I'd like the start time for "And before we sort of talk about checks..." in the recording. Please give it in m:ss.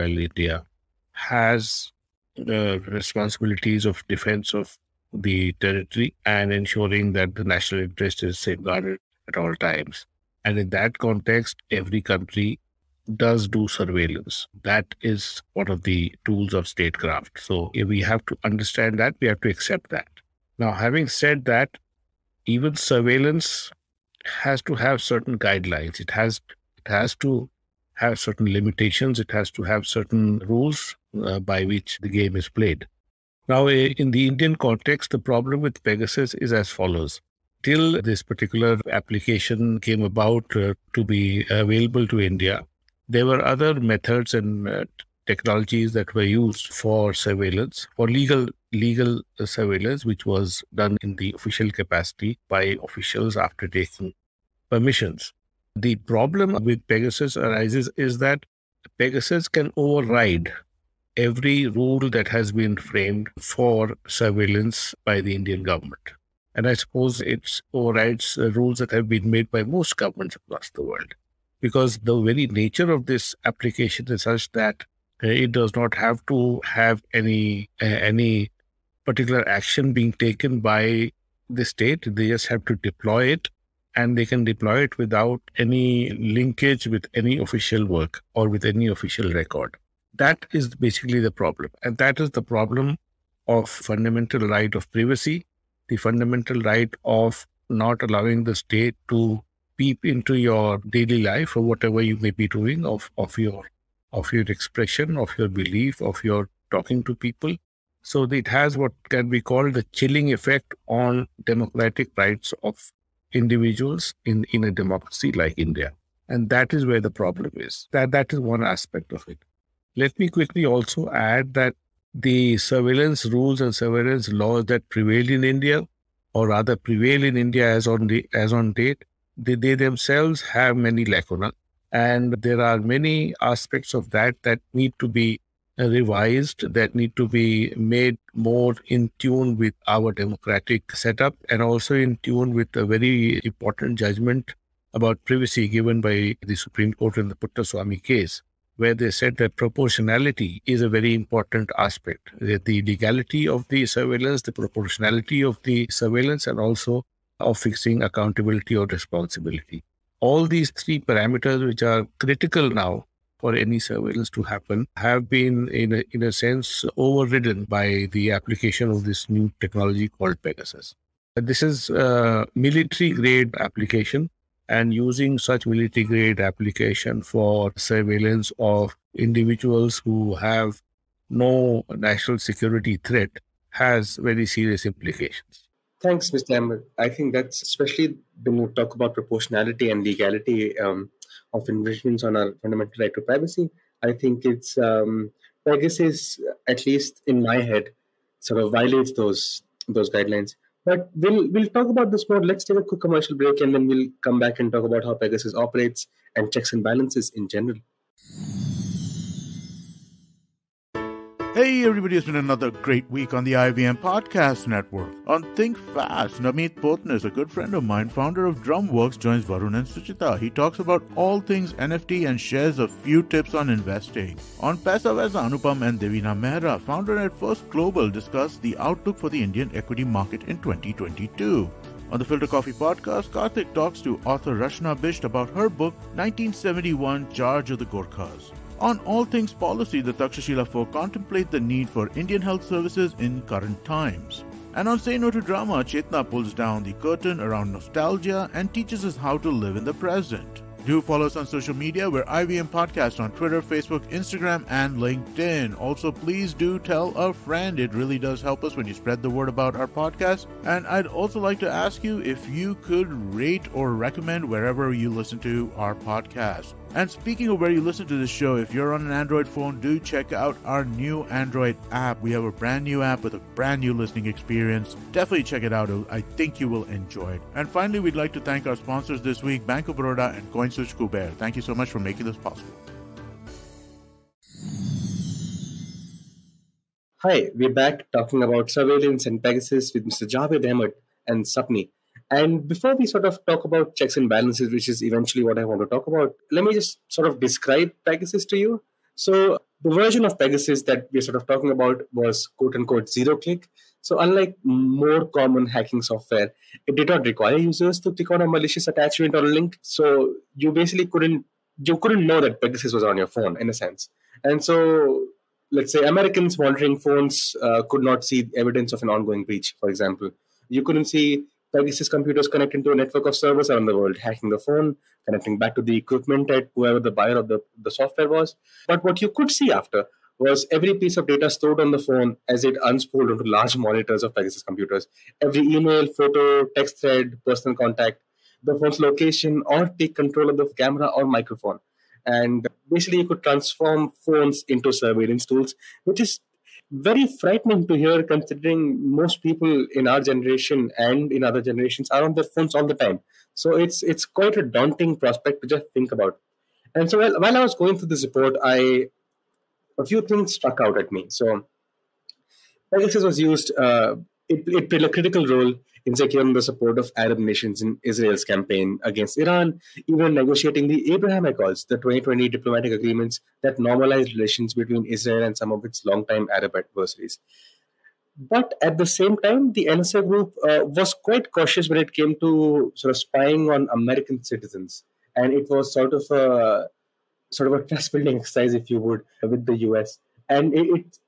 4:52.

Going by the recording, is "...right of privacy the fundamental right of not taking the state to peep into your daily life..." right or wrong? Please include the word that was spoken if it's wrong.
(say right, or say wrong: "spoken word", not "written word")
wrong: "allowing", not "taking".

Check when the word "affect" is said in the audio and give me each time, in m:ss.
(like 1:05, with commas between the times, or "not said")
not said.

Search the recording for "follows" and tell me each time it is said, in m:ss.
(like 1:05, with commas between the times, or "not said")
0:36, 4:11.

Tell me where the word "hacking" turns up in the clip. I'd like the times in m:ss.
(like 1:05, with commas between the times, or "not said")
5:05, 5:24.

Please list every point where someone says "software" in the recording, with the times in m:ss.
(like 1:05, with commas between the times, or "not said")
5:06, 5:27.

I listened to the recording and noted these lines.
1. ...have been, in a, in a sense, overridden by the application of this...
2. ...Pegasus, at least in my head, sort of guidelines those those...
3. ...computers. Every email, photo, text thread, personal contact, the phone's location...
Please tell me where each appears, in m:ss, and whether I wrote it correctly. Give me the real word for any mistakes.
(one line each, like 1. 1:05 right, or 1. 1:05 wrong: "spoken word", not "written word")
1. 2:44 right
2. 3:15 wrong: "violates", not "guidelines"
3. 5:34 right.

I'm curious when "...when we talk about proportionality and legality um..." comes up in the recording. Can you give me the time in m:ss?
3:08.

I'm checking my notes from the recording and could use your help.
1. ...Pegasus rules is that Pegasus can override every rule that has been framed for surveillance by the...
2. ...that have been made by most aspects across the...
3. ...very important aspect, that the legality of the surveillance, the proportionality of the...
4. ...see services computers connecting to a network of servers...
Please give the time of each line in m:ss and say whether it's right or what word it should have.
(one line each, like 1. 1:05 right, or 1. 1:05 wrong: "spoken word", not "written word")
1. 0:56 wrong: "arises", not "rules"
2. 1:08 wrong: "governments", not "aspects"
3. 2:30 right
4. 5:21 right.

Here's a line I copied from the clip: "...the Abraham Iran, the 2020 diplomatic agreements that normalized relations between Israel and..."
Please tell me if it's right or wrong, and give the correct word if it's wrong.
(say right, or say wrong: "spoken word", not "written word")
wrong: "Accords", not "Iran".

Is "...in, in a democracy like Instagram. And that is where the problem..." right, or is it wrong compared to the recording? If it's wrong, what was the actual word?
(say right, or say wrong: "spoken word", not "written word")
wrong: "India", not "Instagram".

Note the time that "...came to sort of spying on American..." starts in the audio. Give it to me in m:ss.
6:22.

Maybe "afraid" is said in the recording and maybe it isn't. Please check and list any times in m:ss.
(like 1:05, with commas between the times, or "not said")
not said.